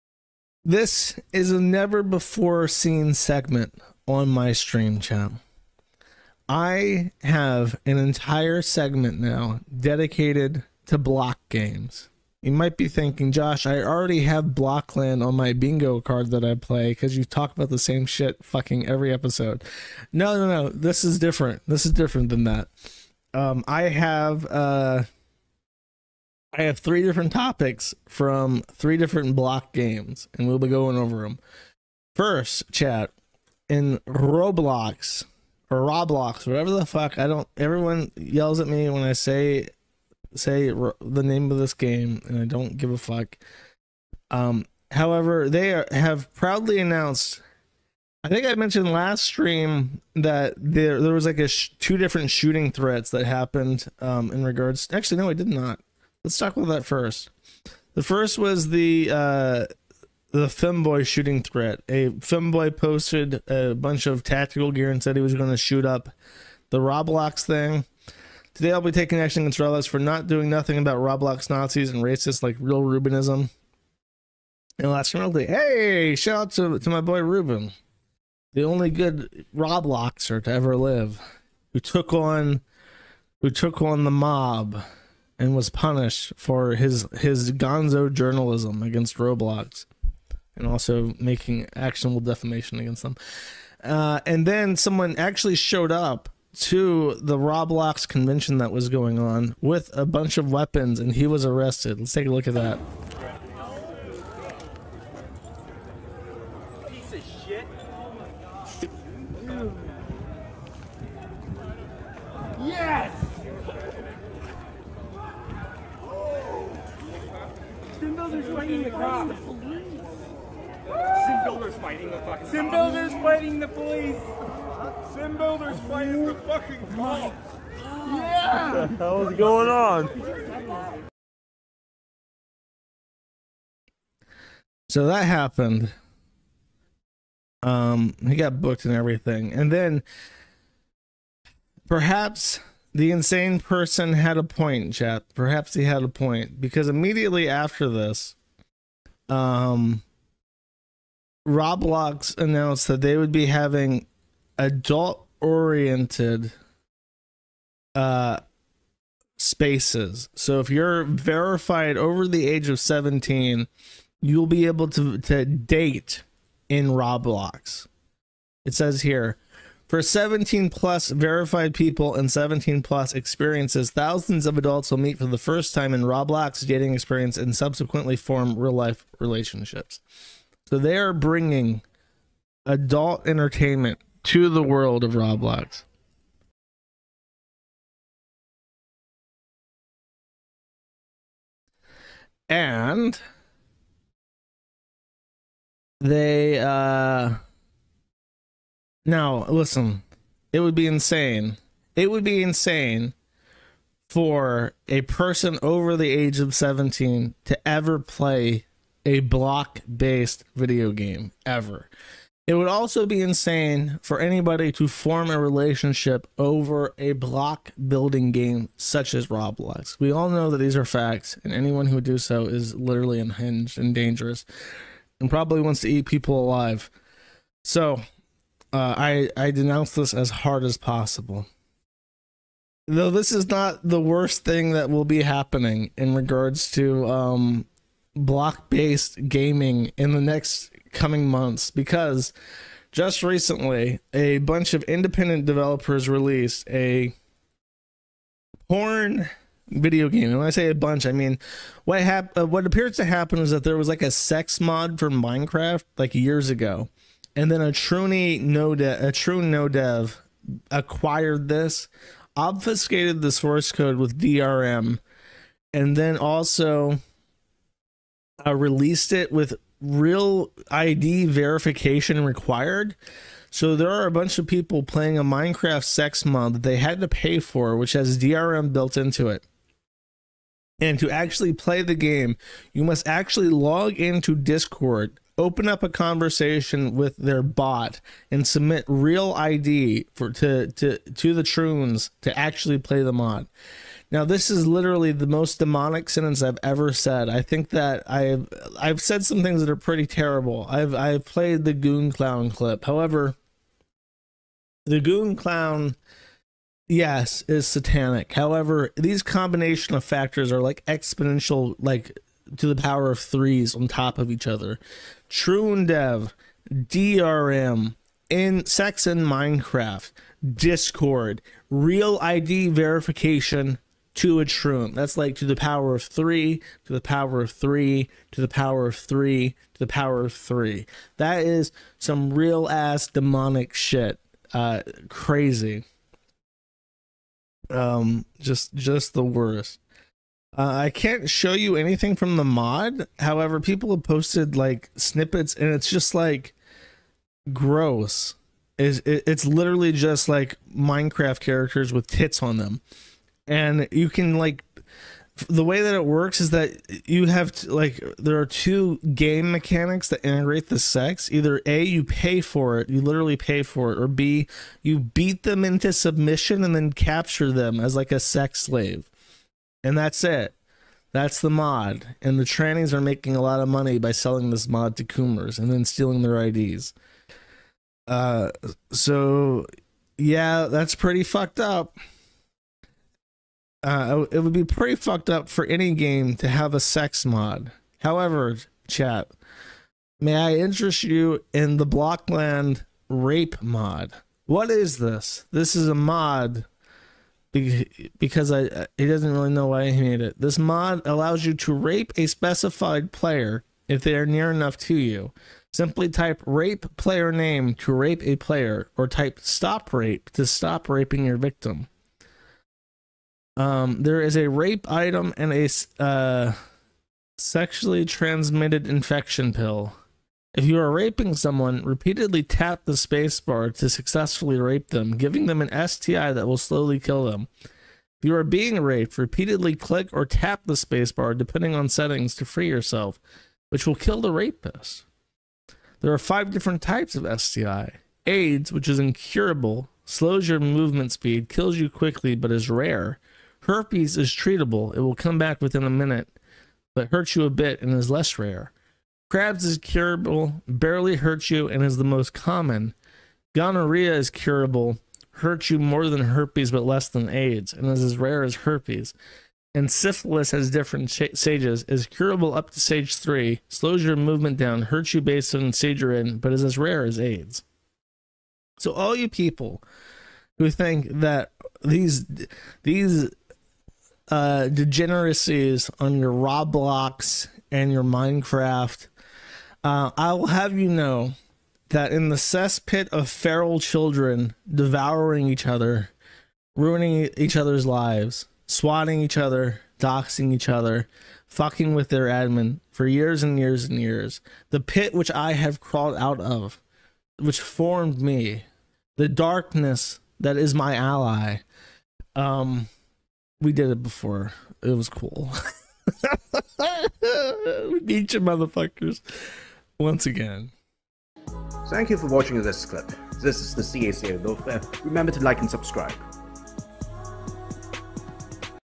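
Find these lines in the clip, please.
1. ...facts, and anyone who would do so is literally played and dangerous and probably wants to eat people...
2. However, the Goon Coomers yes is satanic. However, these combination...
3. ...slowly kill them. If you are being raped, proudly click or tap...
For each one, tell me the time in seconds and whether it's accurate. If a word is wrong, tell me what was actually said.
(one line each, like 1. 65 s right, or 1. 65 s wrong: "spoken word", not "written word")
1. 220 s wrong: "unhinged", not "played"
2. 302 s wrong: "Clown", not "Coomers"
3. 426 s wrong: "repeatedly", not "proudly".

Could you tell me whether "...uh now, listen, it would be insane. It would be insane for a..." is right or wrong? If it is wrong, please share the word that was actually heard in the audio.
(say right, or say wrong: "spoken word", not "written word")
right.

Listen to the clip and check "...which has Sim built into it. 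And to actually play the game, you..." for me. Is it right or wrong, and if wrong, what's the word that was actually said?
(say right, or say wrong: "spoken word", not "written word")
wrong: "DRM", not "Sim".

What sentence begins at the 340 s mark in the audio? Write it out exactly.
Uh, I can't show you anything from the mod.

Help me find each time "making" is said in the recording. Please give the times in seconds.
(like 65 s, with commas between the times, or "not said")
91 s, 373 s.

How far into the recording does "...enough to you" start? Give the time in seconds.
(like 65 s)
404 s.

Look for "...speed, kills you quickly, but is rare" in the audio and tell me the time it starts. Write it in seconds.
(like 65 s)
441 s.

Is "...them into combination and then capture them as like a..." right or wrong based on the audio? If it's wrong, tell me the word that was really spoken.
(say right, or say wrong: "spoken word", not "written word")
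wrong: "submission", not "combination".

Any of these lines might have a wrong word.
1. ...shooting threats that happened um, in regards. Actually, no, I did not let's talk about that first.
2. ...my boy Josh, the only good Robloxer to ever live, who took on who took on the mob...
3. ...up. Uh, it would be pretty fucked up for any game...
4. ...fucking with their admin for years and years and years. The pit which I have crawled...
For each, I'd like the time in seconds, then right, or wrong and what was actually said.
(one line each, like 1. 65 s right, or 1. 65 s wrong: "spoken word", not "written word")
1. 52 s right
2. 76 s wrong: "Ruben", not "Josh"
3. 381 s right
4. 491 s right.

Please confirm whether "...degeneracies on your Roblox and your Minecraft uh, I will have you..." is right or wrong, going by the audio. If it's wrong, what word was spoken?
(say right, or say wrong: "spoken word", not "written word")
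right.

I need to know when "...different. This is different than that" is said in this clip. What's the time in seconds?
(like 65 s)
21 s.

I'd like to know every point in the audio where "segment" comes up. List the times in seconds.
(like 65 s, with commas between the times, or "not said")
3 s, 8 s.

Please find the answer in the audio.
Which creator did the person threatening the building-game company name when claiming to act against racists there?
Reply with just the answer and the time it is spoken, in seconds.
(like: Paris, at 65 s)
Ruben Sim, at 72 s.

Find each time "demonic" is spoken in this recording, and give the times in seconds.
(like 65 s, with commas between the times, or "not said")
295 s, 333 s.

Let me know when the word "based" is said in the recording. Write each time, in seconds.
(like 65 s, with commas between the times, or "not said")
209 s, 238 s, 465 s.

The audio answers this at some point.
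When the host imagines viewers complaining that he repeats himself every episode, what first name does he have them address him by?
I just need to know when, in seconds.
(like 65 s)
13 s.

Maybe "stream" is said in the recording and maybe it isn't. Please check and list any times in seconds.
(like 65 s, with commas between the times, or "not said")
4 s, 49 s.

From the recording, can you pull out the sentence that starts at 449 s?
Crabs is curable, barely hurts you, and is the most common.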